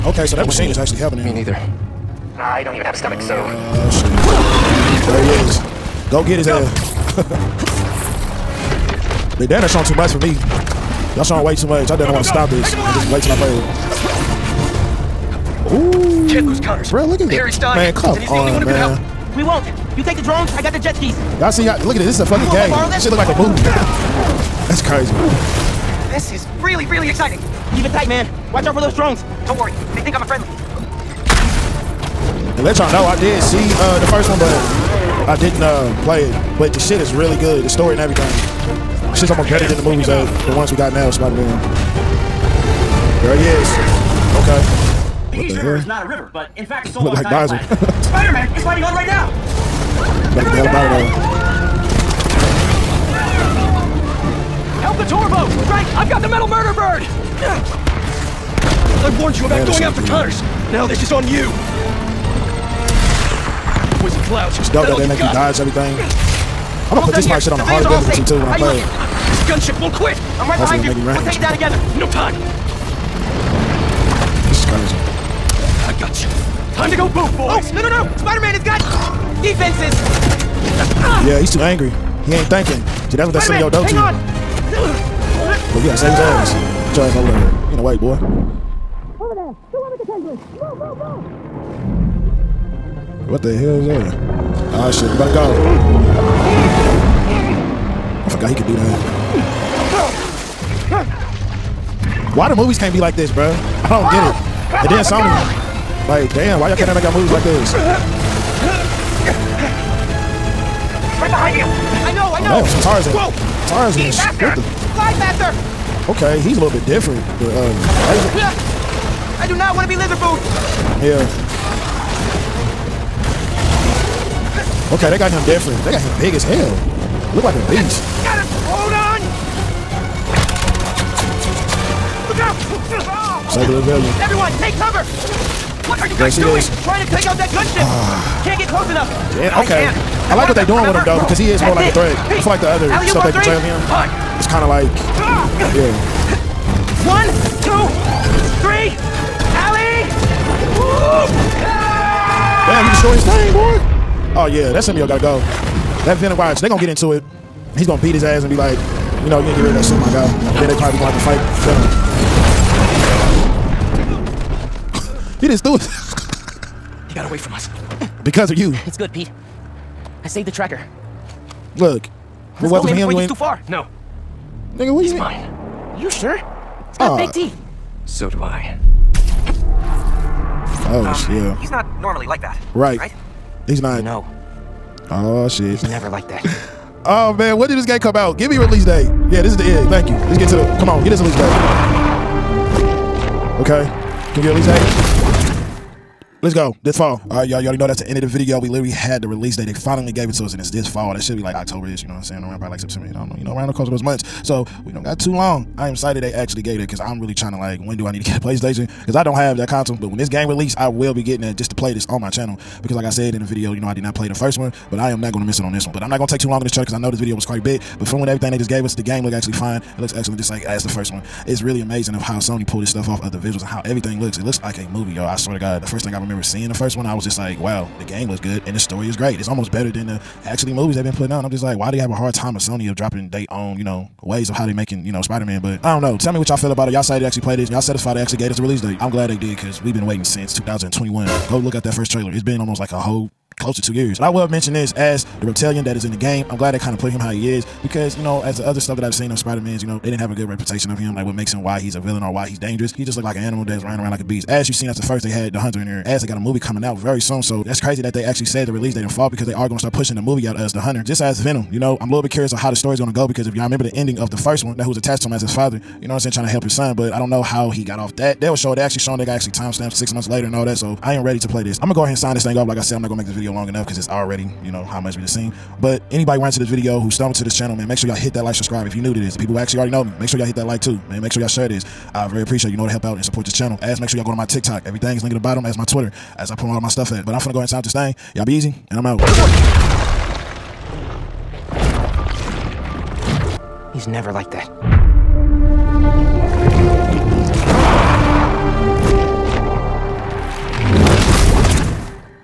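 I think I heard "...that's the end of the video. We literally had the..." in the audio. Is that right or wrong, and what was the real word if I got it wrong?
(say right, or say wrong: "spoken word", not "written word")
right.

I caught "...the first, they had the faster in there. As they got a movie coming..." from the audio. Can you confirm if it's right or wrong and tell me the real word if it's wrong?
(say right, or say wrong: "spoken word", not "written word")
wrong: "hunter", not "faster".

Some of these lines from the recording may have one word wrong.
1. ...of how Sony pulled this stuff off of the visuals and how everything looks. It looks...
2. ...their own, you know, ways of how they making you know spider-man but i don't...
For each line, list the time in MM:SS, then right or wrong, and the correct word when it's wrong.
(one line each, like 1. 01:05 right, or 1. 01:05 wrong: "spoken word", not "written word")
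1. 03:42 right
2. 03:53 right.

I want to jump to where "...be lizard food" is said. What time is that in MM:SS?
01:59.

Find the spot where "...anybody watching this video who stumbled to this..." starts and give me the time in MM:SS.
04:36.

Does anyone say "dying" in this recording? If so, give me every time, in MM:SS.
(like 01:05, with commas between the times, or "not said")
00:17.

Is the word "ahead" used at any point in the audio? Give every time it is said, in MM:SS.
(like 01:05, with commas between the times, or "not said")
04:32, 04:47.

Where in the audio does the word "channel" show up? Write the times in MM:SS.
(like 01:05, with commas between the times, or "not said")
03:32, 04:37, 04:43.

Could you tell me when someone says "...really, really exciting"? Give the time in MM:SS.
00:26.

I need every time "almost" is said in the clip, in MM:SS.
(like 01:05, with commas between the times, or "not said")
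00:39, 01:07, 03:49, 04:02.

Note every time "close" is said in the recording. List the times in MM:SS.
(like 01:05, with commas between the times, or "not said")
02:18, 04:03.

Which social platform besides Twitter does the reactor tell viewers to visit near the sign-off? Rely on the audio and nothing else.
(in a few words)
TikTok.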